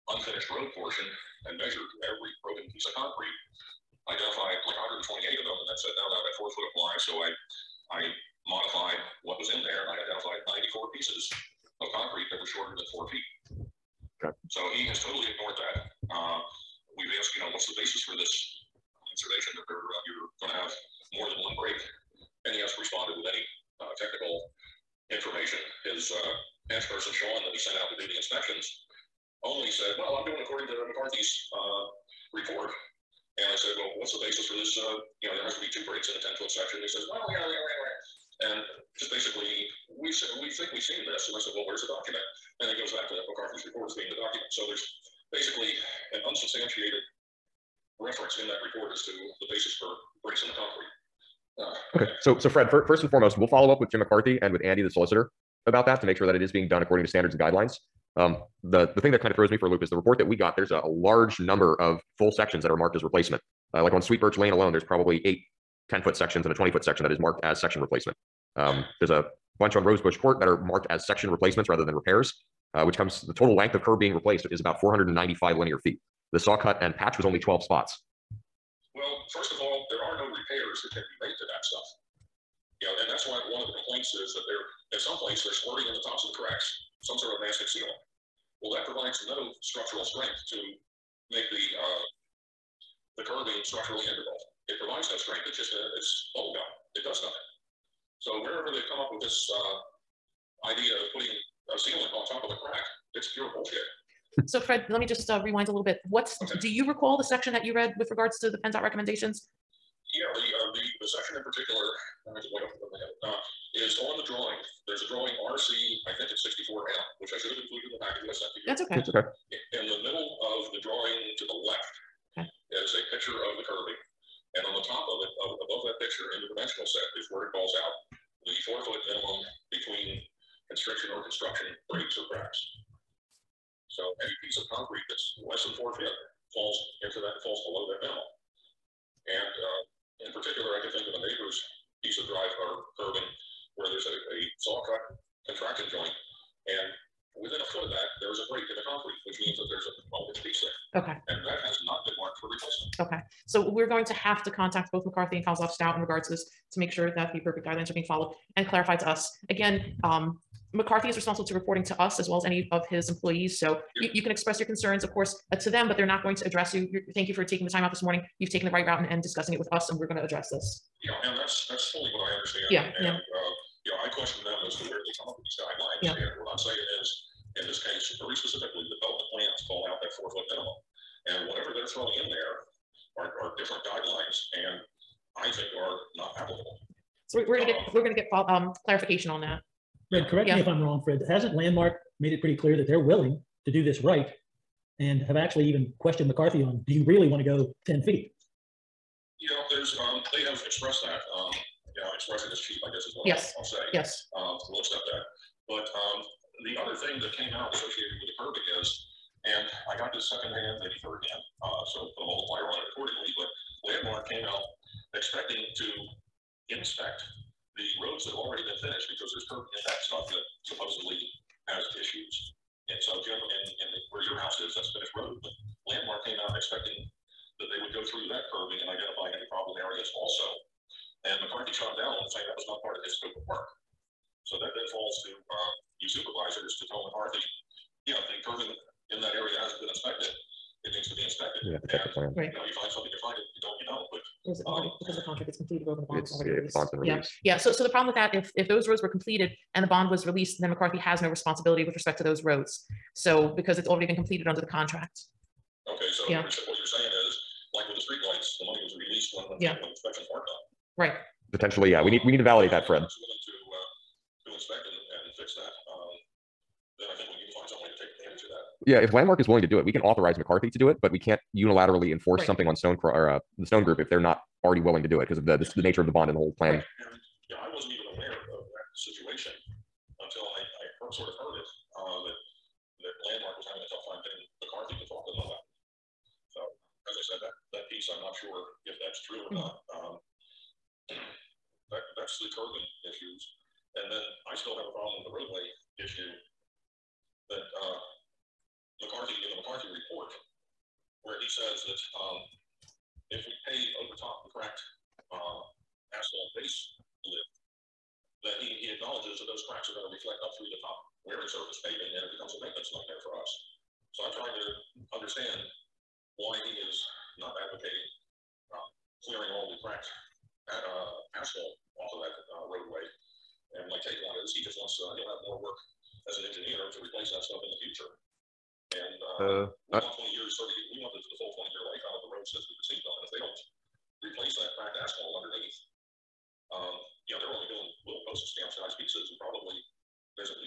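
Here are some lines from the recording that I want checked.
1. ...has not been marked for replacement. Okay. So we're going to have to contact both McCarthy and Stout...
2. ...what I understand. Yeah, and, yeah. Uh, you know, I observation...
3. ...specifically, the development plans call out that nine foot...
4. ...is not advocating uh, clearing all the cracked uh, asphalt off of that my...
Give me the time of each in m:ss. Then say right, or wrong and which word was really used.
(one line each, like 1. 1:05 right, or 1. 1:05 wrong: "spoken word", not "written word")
1. 2:31 wrong: "Kozlov", not "Stout"
2. 2:52 wrong: "question", not "observation"
3. 2:58 wrong: "four", not "nine"
4. 5:16 right.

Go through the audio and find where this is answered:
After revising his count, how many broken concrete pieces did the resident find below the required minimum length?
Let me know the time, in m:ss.
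0:10.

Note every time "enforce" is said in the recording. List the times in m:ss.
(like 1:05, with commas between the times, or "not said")
4:32.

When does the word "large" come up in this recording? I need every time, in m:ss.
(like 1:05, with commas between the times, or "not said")
1:00.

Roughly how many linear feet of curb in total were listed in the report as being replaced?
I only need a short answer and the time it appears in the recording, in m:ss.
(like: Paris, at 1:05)
495, at 1:14.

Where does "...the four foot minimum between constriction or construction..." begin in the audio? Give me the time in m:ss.
2:08.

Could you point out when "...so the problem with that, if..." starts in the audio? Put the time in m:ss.
4:07.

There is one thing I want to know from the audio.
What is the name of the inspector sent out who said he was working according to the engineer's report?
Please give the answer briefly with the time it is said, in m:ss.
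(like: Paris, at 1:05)
Sean, at 0:27.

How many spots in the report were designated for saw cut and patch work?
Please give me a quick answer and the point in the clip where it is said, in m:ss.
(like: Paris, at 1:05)
12, at 1:17.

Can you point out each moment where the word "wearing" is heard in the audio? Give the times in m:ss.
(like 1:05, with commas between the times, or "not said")
5:11.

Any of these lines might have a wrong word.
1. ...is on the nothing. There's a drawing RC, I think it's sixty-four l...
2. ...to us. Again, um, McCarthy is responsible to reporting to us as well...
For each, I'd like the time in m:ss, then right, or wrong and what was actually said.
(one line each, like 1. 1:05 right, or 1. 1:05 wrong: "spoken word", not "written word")
1. 1:53 wrong: "drawing", not "nothing"
2. 2:38 right.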